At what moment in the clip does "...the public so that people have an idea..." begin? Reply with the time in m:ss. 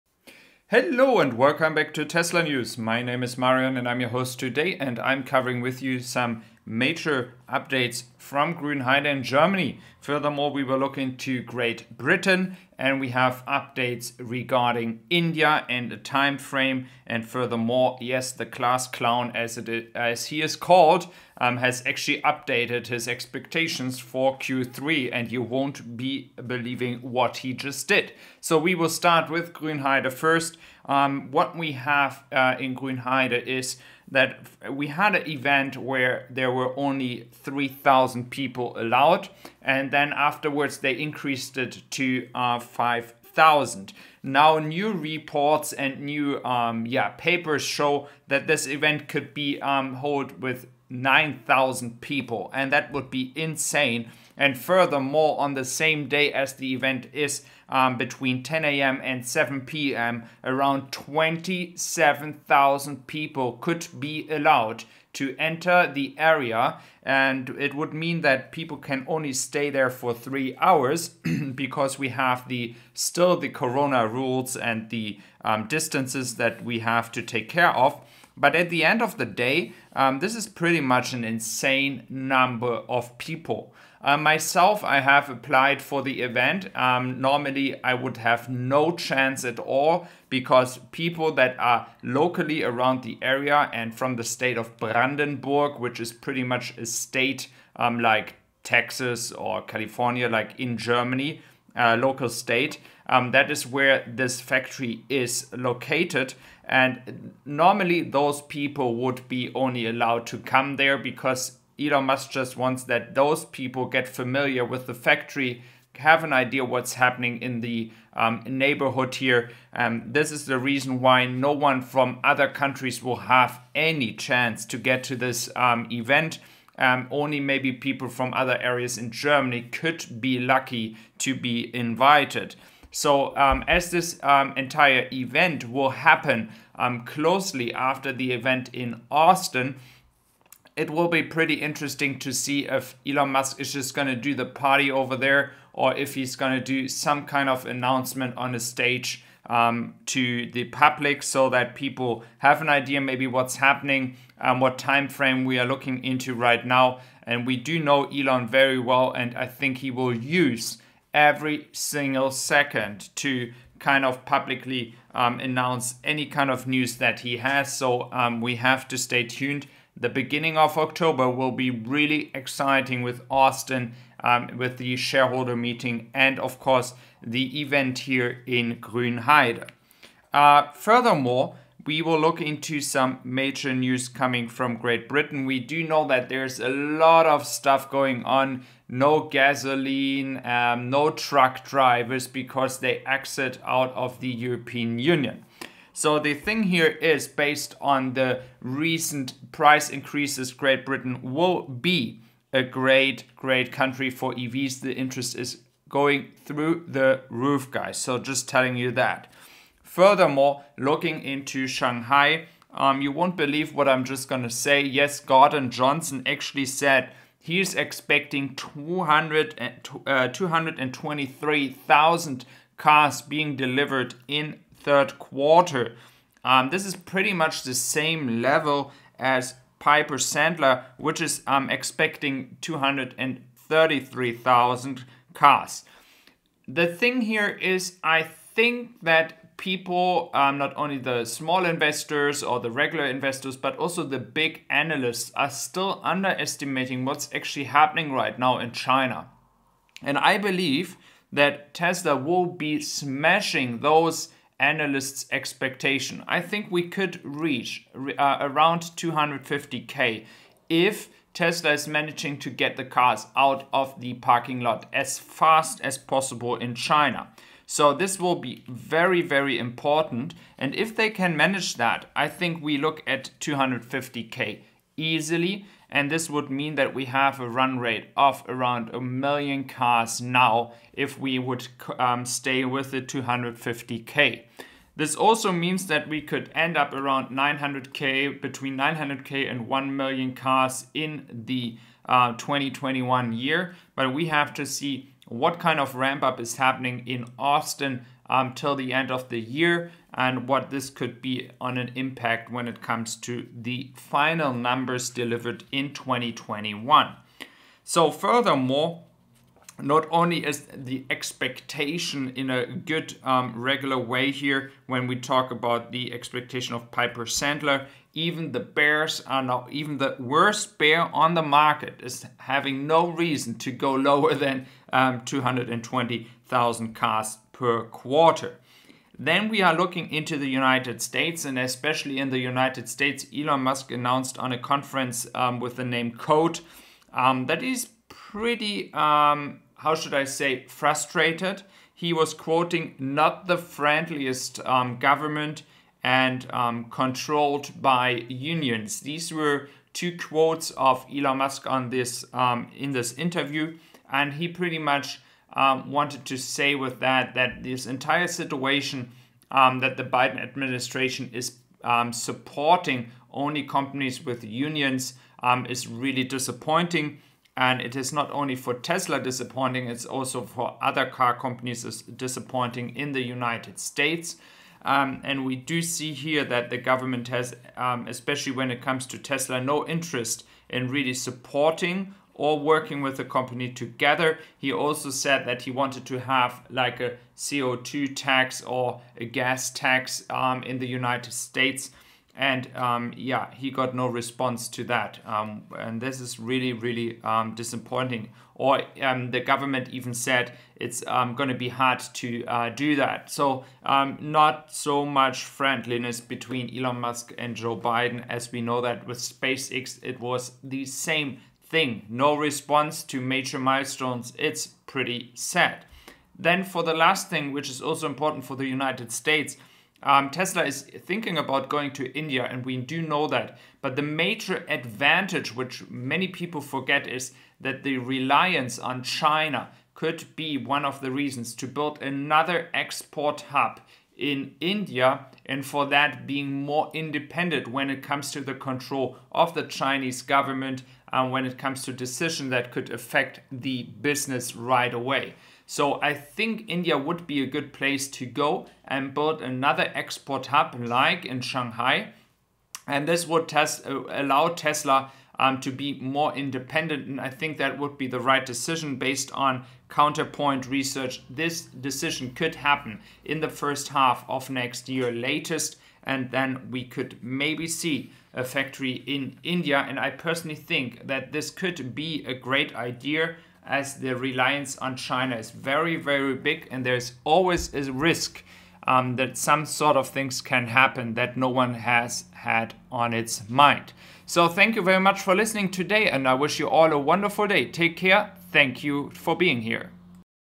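2:30.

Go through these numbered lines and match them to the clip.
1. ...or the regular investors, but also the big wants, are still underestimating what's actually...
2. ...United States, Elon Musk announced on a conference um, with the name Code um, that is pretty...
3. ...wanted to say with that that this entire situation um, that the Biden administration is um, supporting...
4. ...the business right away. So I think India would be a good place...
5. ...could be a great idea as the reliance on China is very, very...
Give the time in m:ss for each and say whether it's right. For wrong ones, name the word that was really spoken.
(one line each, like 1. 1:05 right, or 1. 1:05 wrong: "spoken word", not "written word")
1. 4:02 wrong: "analysts", not "wants"
2. 5:32 right
3. 5:55 right
4. 7:23 right
5. 7:51 right.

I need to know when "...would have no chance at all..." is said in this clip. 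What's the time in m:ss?
1:27.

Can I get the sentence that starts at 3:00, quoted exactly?
Uh, furthermore, we will look into some major news coming from Great Britain.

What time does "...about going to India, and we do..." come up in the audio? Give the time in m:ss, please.
7:01.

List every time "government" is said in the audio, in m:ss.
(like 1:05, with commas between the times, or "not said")
5:44, 6:16, 6:39, 7:20.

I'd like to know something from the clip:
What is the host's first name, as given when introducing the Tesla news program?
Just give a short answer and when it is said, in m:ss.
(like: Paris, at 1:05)
Marian, at 0:03.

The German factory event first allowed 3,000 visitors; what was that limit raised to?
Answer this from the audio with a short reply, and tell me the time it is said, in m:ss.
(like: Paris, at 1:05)
5,000, at 0:42.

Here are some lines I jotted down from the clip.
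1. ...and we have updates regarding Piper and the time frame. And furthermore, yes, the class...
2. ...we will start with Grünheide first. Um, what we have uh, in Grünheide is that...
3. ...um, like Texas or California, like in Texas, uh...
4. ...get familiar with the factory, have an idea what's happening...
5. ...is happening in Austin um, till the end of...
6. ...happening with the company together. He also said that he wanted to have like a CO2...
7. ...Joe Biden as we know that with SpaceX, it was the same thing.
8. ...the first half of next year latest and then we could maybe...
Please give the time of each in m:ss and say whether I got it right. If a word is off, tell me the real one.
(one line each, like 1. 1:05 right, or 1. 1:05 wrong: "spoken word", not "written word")
1. 0:12 wrong: "India", not "Piper"
2. 0:28 right
3. 1:37 wrong: "Germany", not "Texas"
4. 1:53 right
5. 4:56 right
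6. 6:22 wrong: "working", not "happening"
7. 6:47 right
8. 7:43 right.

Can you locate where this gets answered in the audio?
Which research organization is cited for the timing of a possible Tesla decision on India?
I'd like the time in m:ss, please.
7:39.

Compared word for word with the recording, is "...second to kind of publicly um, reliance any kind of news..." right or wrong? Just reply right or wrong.
wrong.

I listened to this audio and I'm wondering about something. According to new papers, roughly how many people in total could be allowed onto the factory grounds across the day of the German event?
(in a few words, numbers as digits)
27,000.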